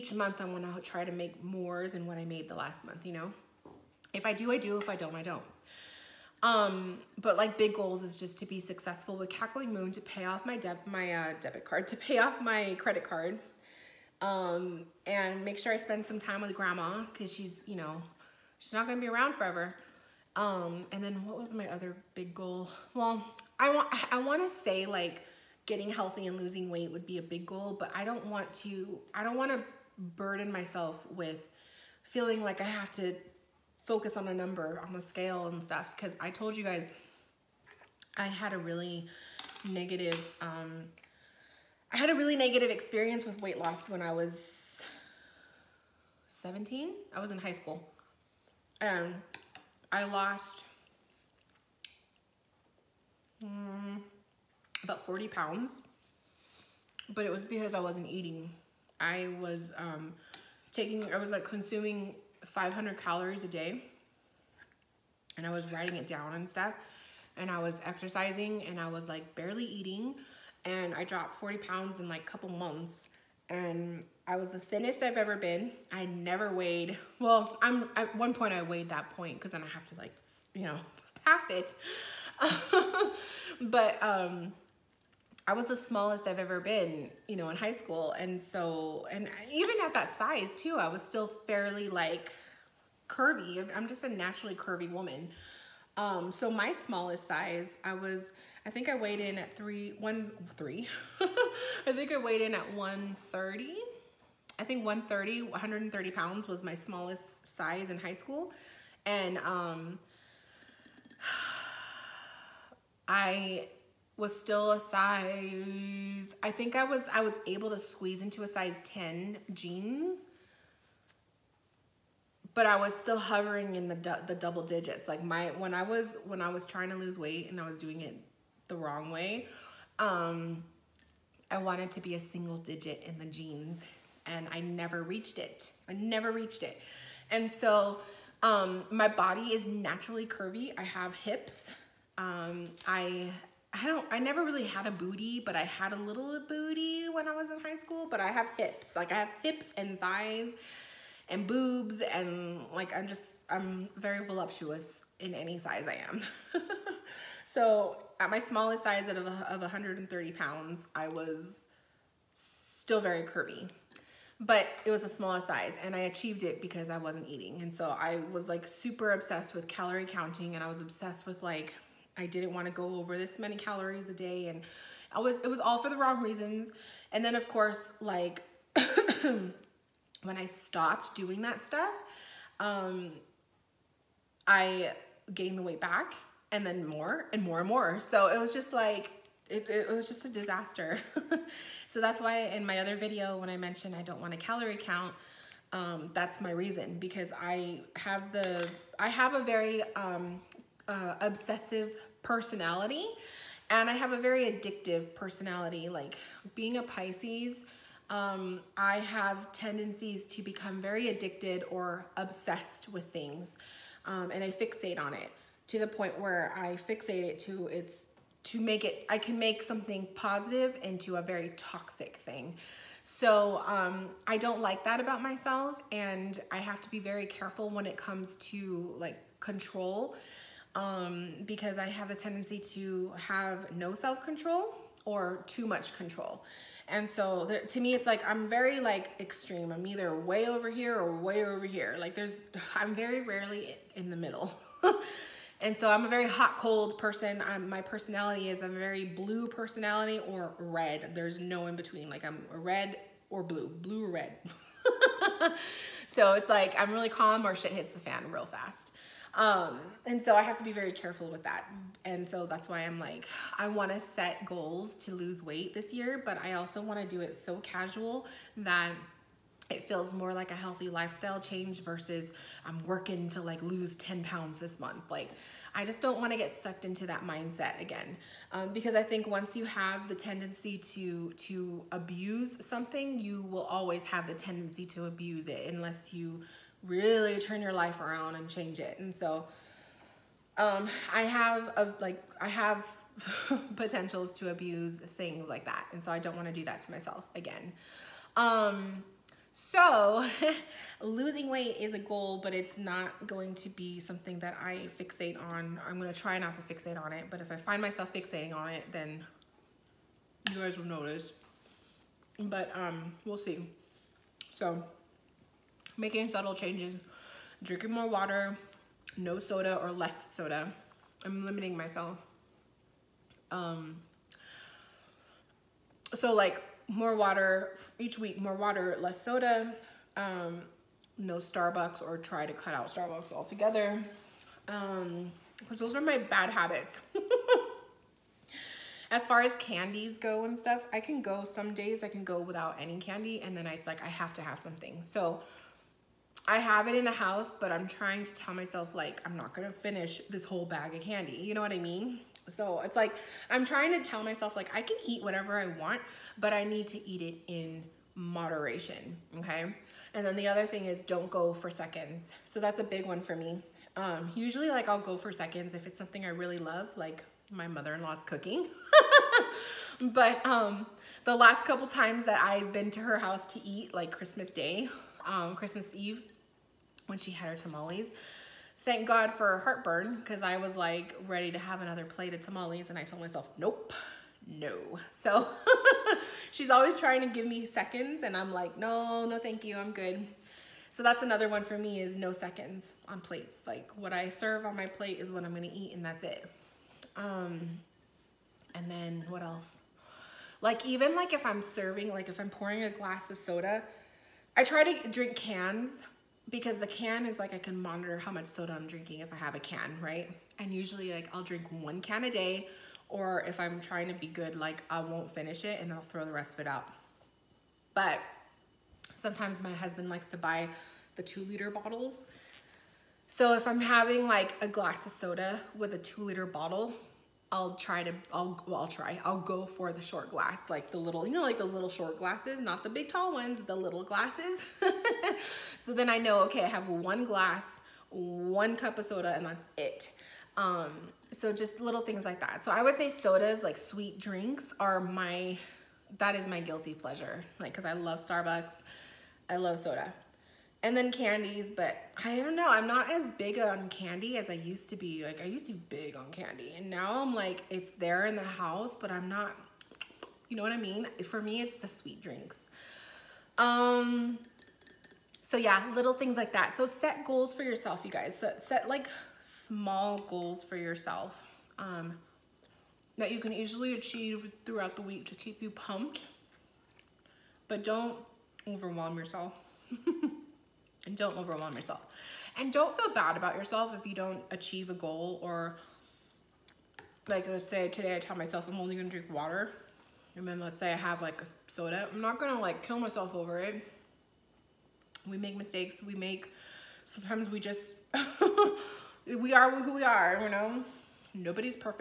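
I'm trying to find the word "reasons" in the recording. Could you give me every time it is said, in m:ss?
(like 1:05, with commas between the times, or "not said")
2:56, 3:16.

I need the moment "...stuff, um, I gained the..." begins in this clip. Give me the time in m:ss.
3:01.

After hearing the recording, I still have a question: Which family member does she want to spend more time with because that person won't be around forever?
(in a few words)
grandma.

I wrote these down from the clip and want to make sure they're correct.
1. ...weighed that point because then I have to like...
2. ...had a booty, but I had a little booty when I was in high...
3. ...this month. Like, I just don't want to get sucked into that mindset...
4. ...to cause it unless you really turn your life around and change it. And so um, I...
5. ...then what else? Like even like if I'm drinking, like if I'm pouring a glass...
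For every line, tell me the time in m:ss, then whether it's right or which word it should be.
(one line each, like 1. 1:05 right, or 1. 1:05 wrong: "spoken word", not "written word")
1. 1:18 right
2. 2:24 right
3. 4:34 right
4. 4:44 wrong: "abuse", not "cause"
5. 6:38 wrong: "serving", not "drinking".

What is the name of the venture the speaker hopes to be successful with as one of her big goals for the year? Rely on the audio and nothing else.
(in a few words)
Cackling Moon.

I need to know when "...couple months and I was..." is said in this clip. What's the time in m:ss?
1:12.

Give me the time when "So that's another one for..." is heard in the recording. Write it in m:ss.
6:30.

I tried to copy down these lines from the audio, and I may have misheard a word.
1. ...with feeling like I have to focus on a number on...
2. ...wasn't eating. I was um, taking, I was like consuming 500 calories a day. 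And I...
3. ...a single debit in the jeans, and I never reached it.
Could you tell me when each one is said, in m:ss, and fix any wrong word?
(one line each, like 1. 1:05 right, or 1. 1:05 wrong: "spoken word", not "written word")
1. 0:31 right
2. 0:57 right
3. 2:12 wrong: "digit", not "debit".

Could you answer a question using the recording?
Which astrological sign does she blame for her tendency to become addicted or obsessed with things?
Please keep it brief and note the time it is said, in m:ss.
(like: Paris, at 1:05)
Pisces, at 3:26.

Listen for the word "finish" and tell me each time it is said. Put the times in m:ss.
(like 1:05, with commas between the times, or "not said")
5:49, 6:55.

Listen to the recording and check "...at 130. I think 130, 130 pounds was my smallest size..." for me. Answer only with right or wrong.
right.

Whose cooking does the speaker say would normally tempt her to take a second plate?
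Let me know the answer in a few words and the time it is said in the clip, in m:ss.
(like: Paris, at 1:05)
mother-in-law, at 6:07.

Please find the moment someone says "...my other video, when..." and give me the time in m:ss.
3:12.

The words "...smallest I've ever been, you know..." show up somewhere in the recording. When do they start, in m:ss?
1:25.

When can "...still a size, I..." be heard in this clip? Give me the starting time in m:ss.
1:54.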